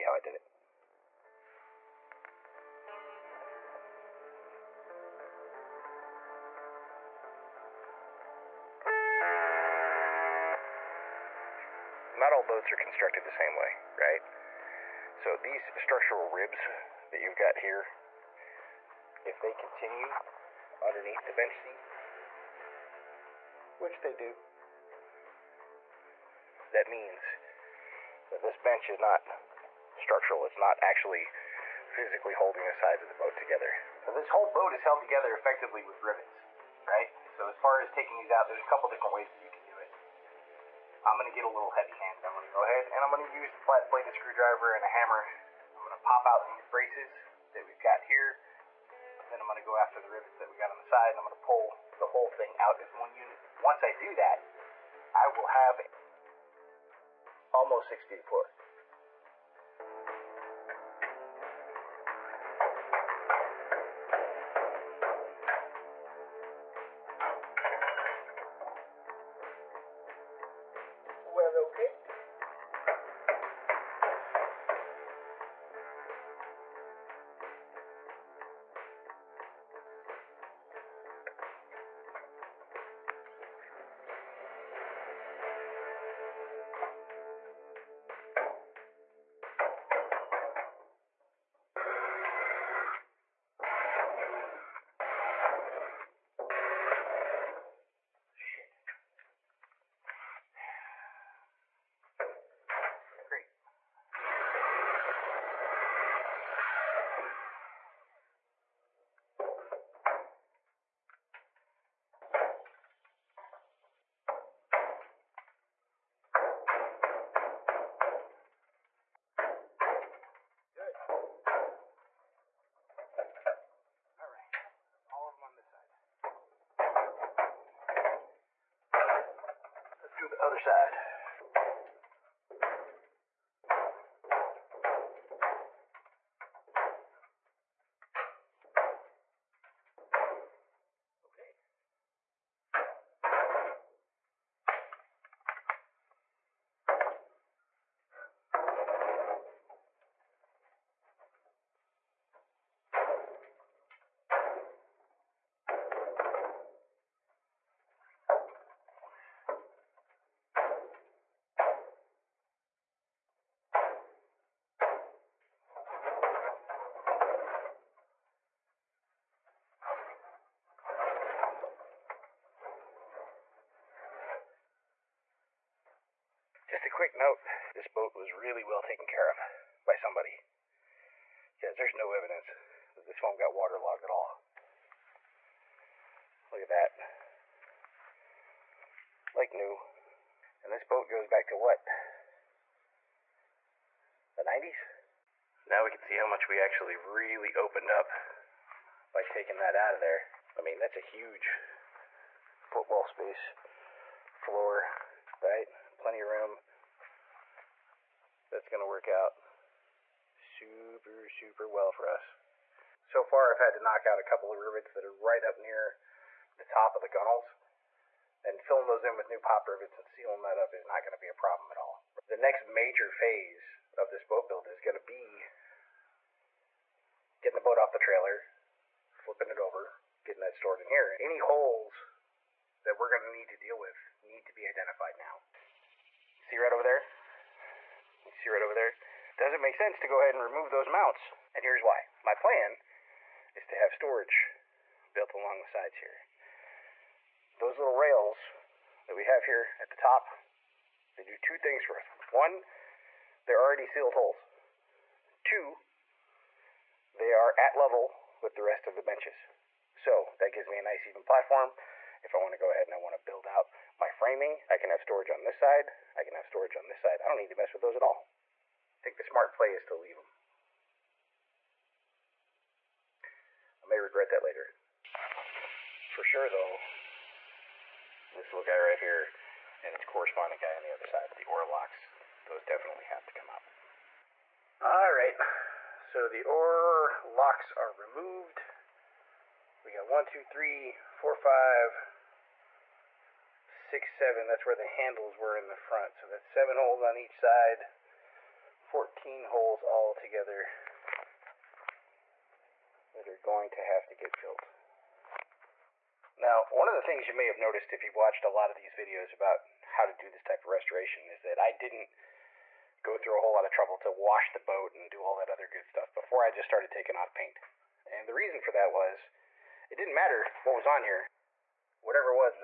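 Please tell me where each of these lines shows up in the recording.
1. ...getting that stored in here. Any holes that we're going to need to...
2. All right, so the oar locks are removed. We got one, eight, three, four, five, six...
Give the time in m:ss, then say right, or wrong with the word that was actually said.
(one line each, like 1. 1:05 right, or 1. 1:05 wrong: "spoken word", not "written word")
1. 3:50 right
2. 4:44 wrong: "two", not "eight".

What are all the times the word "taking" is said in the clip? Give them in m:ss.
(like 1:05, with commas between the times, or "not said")
0:37, 3:19, 5:16.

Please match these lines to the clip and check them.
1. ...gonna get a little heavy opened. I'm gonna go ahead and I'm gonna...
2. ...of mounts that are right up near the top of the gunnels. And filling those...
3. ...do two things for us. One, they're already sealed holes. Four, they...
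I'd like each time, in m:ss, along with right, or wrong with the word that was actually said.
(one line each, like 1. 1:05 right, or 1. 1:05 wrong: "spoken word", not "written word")
1. 0:41 wrong: "handed", not "opened"
2. 3:34 wrong: "rivets", not "mounts"
3. 4:11 wrong: "Two", not "Four".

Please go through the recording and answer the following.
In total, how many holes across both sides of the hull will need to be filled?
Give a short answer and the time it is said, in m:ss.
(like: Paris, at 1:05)
14, at 4:58.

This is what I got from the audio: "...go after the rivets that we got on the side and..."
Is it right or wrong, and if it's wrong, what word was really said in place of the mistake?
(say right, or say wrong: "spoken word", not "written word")
right.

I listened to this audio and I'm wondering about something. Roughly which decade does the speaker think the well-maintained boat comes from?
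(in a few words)
The 90s.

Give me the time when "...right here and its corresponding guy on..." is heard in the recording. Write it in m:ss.
4:38.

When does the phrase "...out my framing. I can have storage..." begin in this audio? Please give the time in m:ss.
4:23.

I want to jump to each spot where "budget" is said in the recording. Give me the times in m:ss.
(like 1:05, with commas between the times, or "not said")
not said.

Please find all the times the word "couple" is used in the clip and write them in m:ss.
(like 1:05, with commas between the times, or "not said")
0:38, 3:34.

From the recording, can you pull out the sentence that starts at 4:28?
I think the smart play is to leave them.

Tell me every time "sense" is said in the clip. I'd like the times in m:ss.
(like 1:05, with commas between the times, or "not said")
3:59.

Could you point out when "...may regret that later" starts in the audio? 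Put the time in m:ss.
4:33.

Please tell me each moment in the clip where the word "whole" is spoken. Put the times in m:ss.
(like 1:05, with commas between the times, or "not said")
0:34, 0:52, 5:13.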